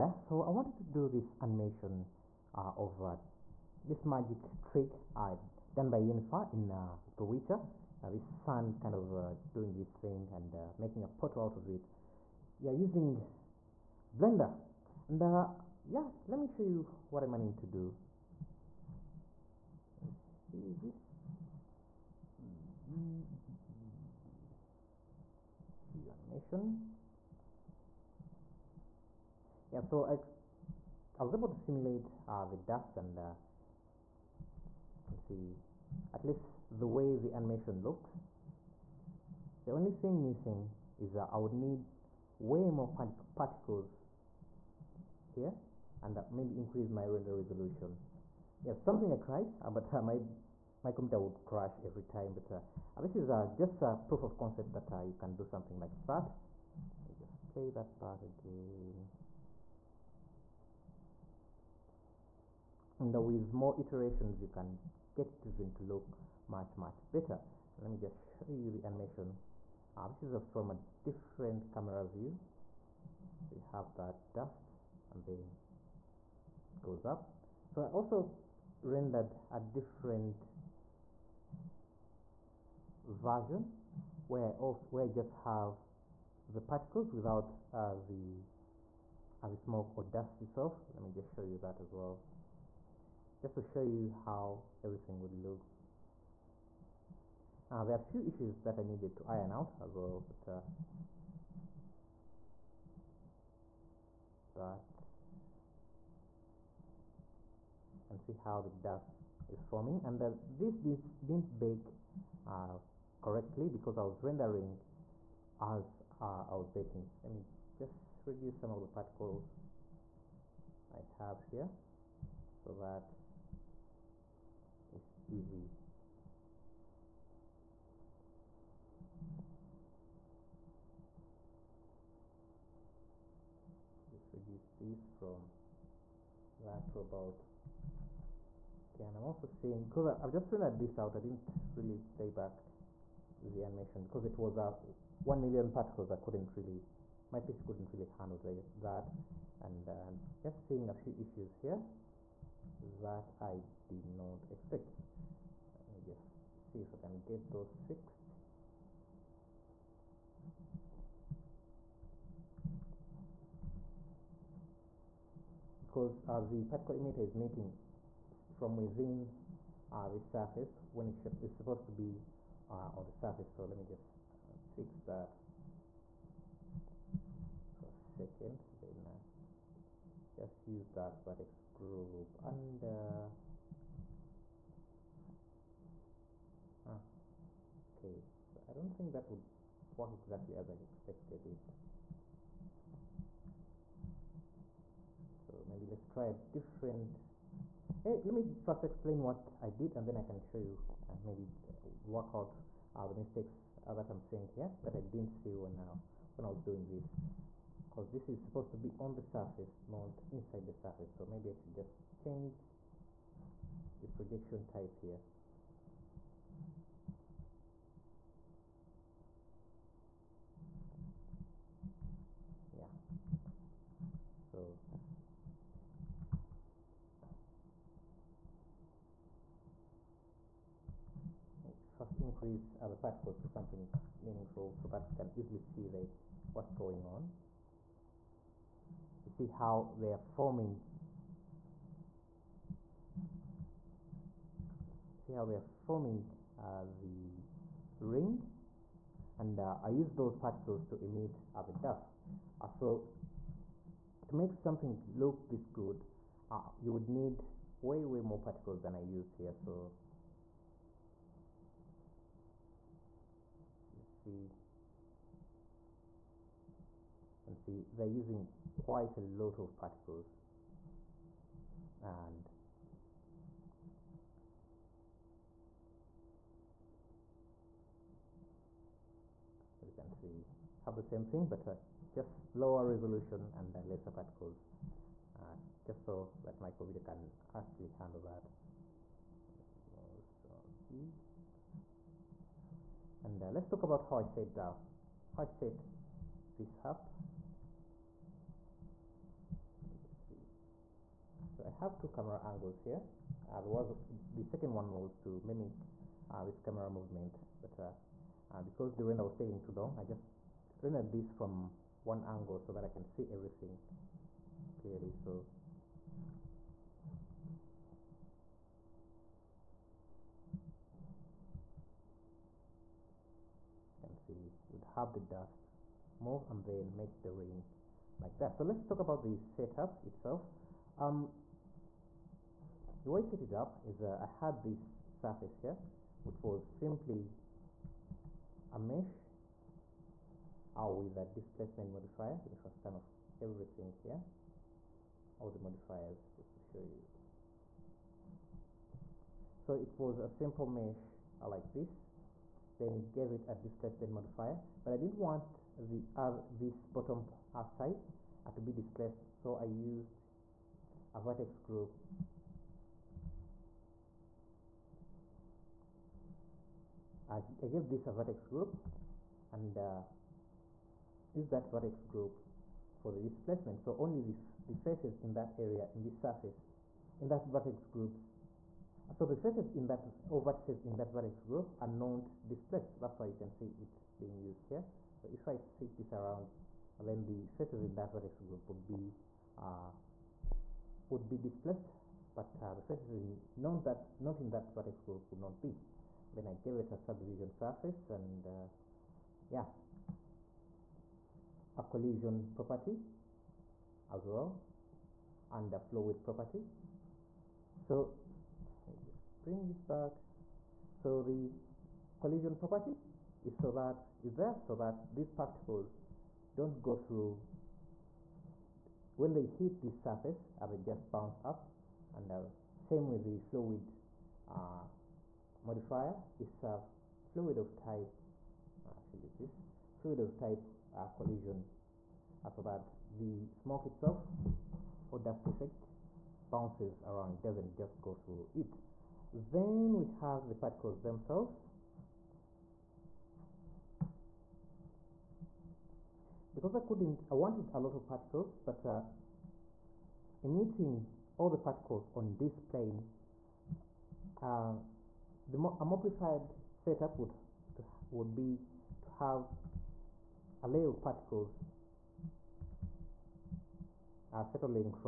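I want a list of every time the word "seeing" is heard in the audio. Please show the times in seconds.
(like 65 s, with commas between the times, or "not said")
139 s, 150 s, 204 s.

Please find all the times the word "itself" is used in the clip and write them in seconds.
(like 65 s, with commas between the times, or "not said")
90 s, 330 s, 433 s.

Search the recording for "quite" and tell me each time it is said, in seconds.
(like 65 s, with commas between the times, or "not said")
268 s.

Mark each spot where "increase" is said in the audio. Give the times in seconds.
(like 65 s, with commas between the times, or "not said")
46 s, 232 s.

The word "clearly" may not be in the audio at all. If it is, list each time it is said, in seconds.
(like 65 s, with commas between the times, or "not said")
314 s.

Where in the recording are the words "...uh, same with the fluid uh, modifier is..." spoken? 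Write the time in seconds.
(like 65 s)
422 s.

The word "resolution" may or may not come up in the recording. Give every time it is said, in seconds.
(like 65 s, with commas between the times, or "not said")
47 s, 282 s.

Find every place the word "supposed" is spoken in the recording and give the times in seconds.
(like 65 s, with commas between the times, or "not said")
171 s, 208 s.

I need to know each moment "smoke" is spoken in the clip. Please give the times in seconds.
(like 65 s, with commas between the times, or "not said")
89 s, 433 s.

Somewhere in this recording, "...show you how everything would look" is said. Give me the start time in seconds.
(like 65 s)
93 s.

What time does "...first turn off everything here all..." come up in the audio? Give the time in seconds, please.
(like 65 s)
342 s.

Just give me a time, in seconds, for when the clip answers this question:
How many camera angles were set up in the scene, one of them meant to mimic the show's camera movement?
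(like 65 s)
301 s.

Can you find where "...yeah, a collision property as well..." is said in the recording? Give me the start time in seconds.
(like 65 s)
399 s.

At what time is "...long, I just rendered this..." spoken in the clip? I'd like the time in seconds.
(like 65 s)
309 s.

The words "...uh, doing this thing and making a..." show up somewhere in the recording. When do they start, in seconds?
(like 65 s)
9 s.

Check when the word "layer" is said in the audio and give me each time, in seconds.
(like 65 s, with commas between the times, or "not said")
460 s.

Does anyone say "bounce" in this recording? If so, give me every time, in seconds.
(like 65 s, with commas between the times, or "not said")
421 s, 436 s.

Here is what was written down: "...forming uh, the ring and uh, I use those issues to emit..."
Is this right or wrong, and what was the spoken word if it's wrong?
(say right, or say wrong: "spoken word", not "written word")
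wrong: "particles", not "issues".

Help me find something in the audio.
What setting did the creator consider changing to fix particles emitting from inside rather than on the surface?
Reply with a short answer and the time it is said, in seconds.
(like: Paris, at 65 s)
projection type, at 214 s.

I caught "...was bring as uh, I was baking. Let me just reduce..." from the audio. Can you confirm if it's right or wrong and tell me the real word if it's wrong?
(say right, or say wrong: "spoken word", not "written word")
wrong: "rendering", not "bring".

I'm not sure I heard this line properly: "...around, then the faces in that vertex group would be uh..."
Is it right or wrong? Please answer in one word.
right.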